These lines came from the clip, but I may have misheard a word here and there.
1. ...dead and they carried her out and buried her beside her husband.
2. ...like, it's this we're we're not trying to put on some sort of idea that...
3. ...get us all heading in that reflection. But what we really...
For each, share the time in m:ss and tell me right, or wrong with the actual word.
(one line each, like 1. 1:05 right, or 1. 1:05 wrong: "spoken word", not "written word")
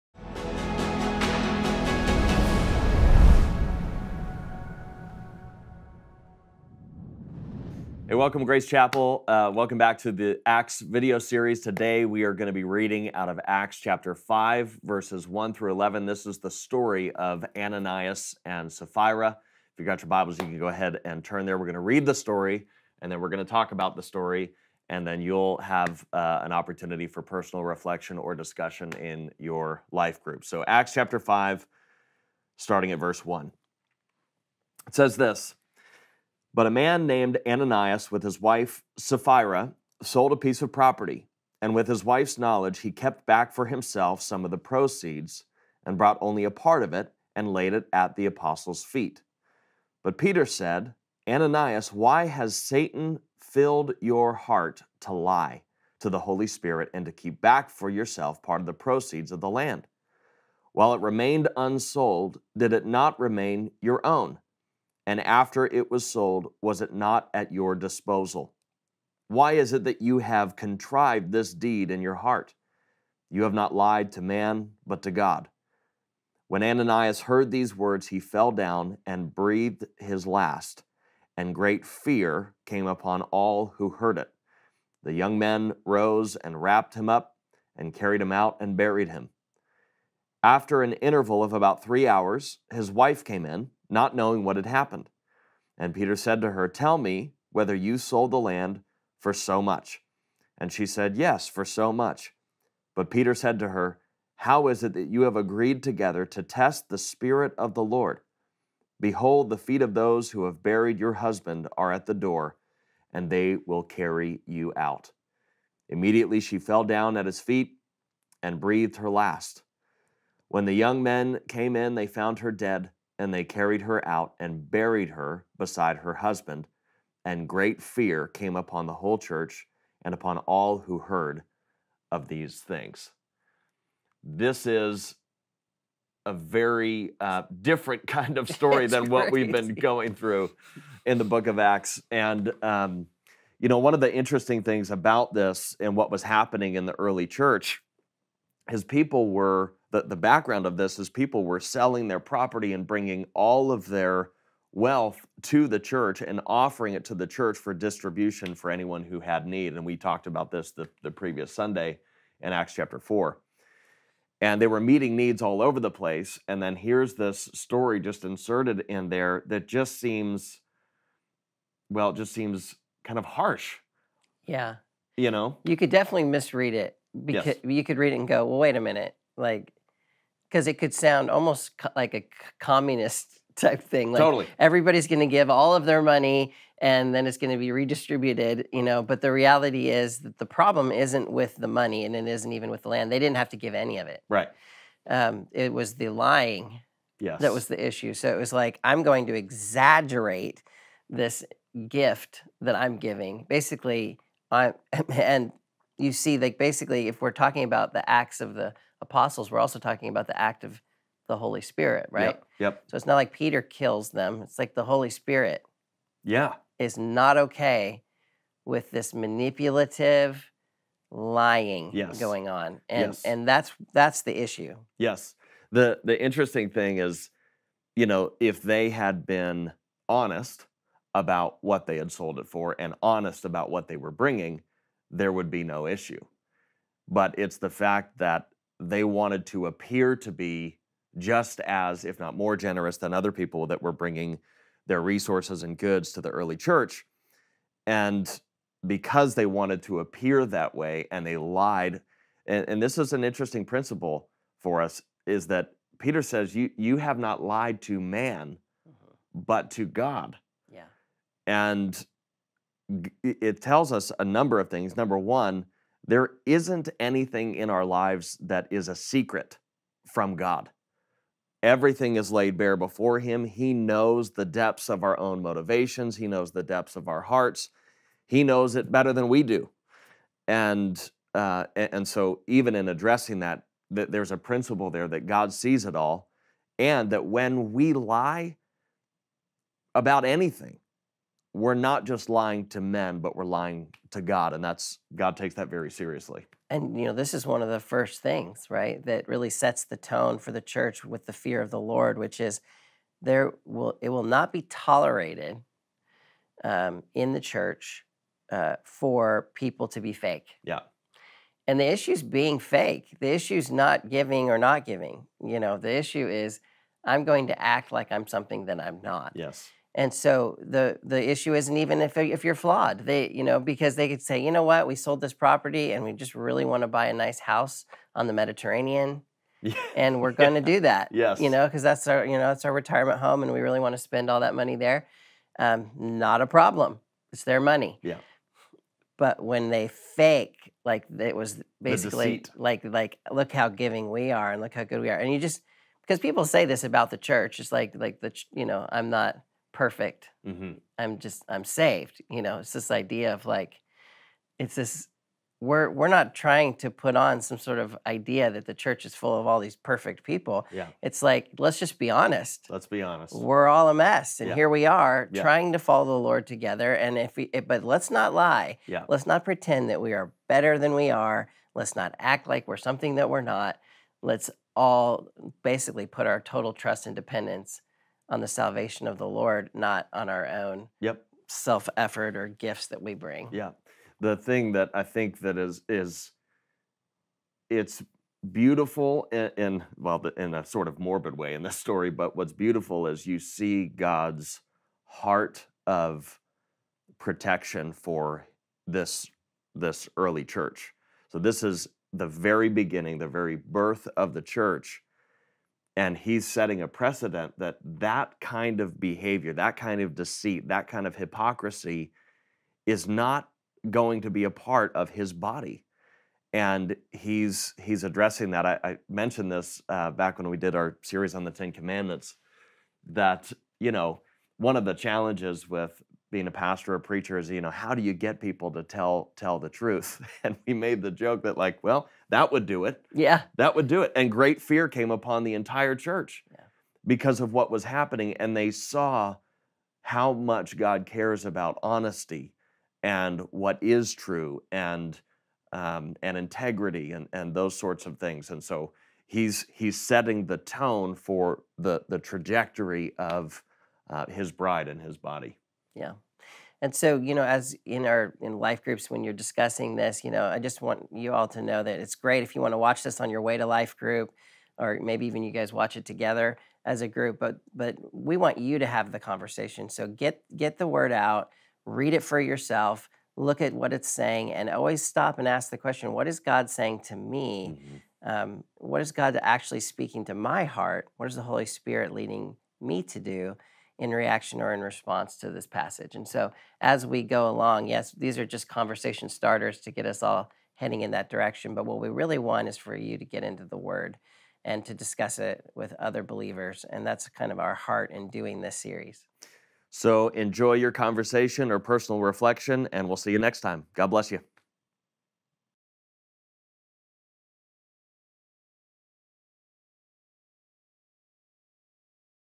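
1. 2:02 right
2. 5:53 right
3. 8:09 wrong: "direction", not "reflection".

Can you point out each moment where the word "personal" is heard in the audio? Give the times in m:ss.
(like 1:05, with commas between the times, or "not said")
0:27, 8:21.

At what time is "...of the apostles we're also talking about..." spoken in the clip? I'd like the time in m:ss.
3:28.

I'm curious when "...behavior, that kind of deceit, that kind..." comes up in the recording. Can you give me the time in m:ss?
6:48.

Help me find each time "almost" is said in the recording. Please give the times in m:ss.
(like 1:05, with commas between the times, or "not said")
3:01.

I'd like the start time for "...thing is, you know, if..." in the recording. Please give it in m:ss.
3:46.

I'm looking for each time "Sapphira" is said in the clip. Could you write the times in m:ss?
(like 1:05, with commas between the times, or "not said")
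0:18, 0:38.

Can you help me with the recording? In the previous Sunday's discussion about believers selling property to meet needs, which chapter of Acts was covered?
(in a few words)
Acts chapter 4.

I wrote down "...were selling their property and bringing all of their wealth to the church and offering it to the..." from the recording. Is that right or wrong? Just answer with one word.
right.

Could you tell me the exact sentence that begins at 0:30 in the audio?
So, Acts chapter 5, starting at verse 1.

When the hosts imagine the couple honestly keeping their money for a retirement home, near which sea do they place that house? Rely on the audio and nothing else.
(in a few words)
The Mediterranean.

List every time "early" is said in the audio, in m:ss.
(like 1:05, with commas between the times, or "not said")
2:26, 4:06, 6:40.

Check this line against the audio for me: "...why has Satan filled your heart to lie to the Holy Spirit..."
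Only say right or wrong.
right.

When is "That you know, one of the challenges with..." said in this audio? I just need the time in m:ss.
7:03.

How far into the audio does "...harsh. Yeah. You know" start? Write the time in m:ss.
2:53.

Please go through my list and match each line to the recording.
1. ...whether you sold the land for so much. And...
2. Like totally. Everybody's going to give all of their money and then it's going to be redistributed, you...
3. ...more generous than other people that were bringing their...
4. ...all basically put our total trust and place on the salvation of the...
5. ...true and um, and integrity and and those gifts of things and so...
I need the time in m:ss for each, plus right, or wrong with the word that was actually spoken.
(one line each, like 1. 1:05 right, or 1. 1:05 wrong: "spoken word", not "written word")
1. 1:37 right
2. 3:04 right
3. 4:02 right
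4. 6:14 wrong: "dependence", not "place"
5. 7:24 wrong: "sorts", not "gifts".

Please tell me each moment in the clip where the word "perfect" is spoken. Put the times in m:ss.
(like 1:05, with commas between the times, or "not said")
5:49, 5:59.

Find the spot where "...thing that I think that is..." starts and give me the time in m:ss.
6:24.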